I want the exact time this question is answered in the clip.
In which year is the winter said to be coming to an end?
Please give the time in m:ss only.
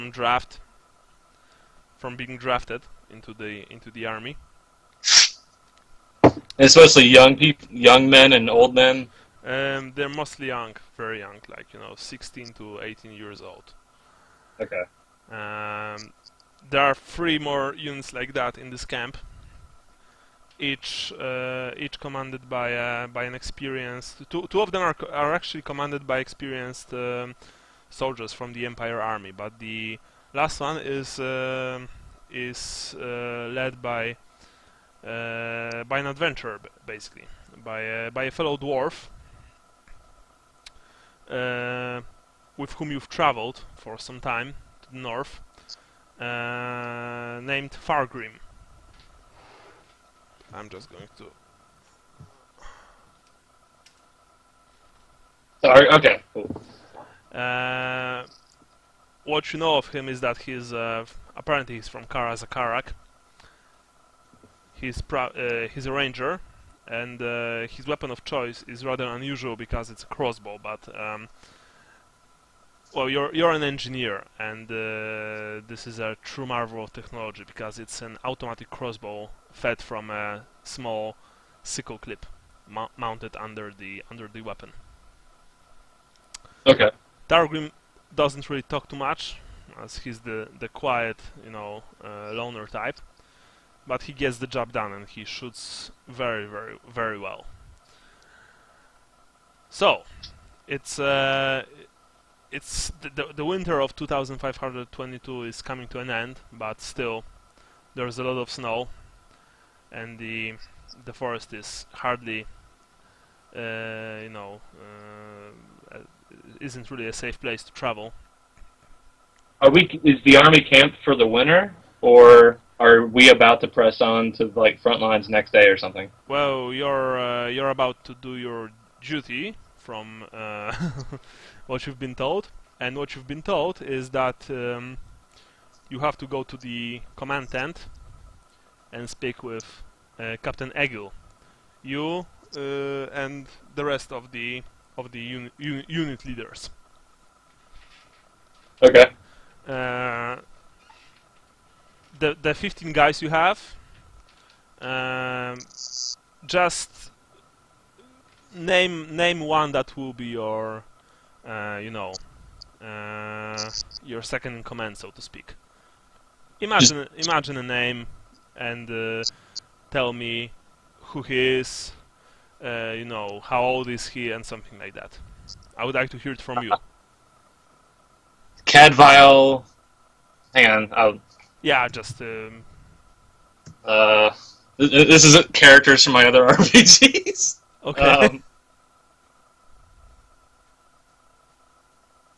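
1:43.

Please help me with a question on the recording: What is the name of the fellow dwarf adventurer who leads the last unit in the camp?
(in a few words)
Fargrim.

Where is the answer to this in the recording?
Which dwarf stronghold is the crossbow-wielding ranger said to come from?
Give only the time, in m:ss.
1:02.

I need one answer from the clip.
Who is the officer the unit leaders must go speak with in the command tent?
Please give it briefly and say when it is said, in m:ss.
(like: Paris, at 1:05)
Captain Egil, at 2:20.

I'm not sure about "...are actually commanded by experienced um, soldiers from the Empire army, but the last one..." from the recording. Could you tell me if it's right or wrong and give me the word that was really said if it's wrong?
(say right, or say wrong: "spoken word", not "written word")
right.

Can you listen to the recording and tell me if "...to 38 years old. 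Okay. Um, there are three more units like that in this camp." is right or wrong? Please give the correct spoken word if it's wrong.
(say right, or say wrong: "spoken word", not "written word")
wrong: "18", not "38".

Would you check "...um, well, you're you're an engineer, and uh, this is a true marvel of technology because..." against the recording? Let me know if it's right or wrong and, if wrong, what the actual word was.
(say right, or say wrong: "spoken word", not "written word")
right.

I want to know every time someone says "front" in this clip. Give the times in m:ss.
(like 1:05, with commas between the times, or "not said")
2:04.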